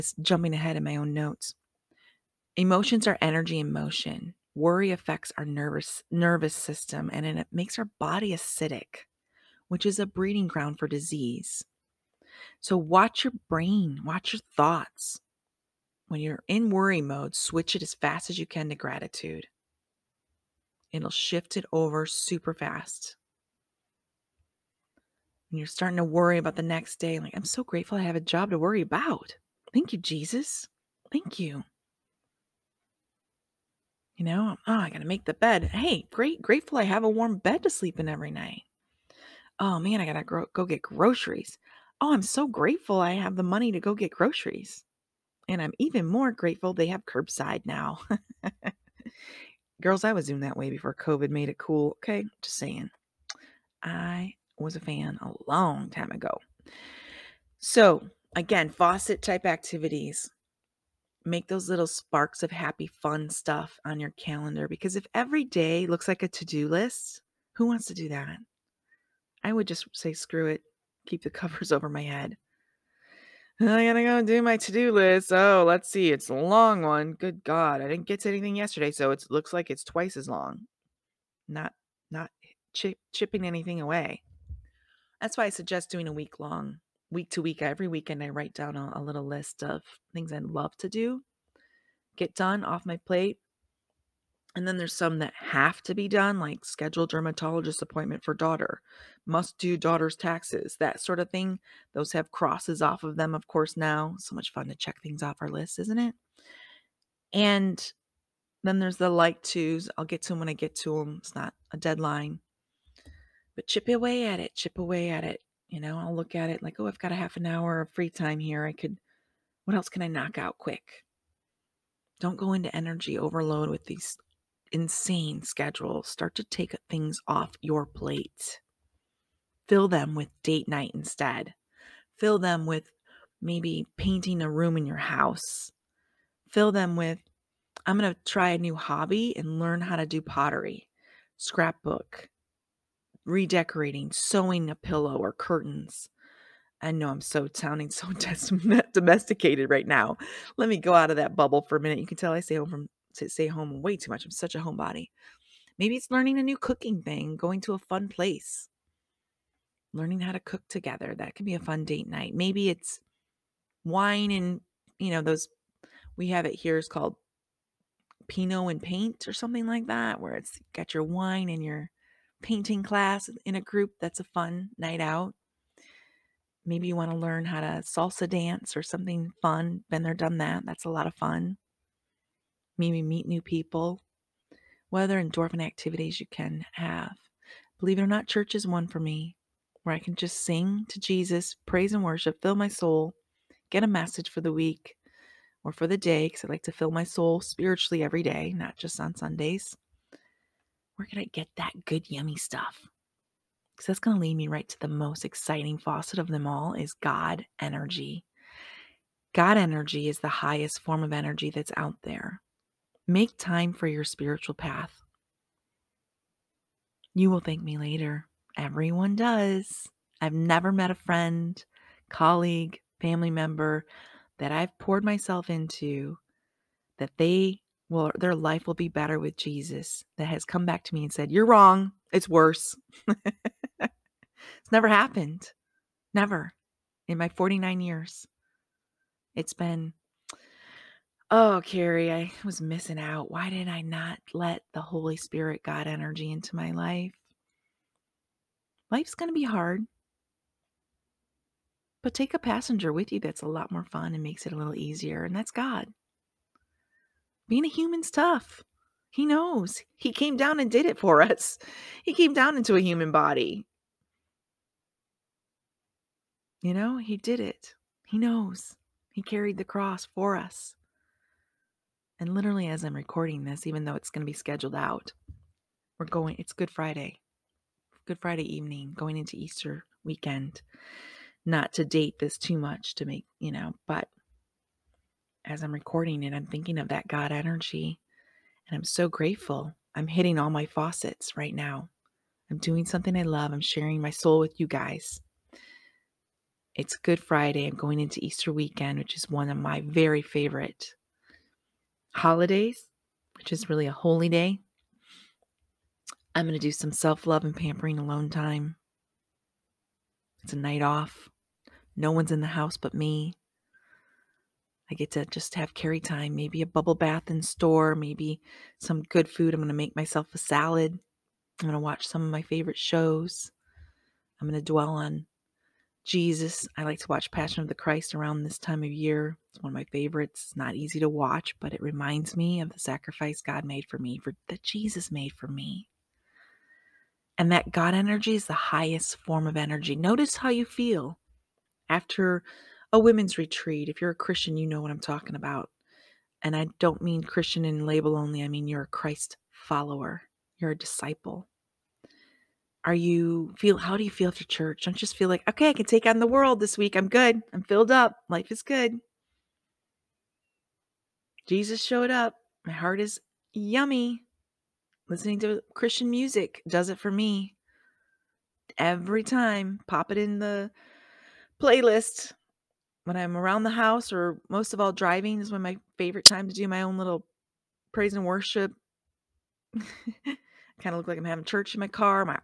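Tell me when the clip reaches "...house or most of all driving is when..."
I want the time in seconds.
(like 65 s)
373 s.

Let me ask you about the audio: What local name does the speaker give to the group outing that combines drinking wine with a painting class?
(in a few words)
Pinot and paint.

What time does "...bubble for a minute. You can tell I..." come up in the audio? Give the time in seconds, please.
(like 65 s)
151 s.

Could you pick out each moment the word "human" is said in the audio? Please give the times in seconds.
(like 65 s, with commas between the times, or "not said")
257 s, 262 s.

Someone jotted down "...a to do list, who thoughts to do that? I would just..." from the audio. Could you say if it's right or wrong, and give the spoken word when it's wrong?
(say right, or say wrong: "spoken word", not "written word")
wrong: "wants", not "thoughts".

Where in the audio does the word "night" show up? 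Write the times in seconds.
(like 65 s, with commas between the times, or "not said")
38 s, 130 s, 162 s, 174 s, 310 s.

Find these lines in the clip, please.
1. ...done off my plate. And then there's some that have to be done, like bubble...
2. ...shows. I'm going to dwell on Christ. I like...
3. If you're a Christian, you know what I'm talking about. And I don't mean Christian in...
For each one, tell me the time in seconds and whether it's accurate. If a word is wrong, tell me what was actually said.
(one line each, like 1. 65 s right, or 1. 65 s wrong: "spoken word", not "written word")
1. 92 s wrong: "schedule", not "bubble"
2. 322 s wrong: "Jesus", not "Christ"
3. 343 s right.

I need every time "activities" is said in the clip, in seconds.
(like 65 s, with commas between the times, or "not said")
59 s, 185 s.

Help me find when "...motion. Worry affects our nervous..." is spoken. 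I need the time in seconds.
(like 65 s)
3 s.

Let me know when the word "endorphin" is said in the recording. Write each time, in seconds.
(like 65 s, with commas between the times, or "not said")
185 s.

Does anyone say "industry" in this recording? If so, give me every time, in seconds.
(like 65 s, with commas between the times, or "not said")
not said.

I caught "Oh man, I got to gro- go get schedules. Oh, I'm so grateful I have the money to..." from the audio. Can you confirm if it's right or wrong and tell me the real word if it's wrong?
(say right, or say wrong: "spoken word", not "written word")
wrong: "groceries", not "schedules".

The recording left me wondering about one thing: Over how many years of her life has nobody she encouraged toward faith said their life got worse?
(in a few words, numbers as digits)
49.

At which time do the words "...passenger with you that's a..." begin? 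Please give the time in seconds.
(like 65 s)
252 s.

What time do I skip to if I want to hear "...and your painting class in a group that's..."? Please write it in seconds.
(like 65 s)
171 s.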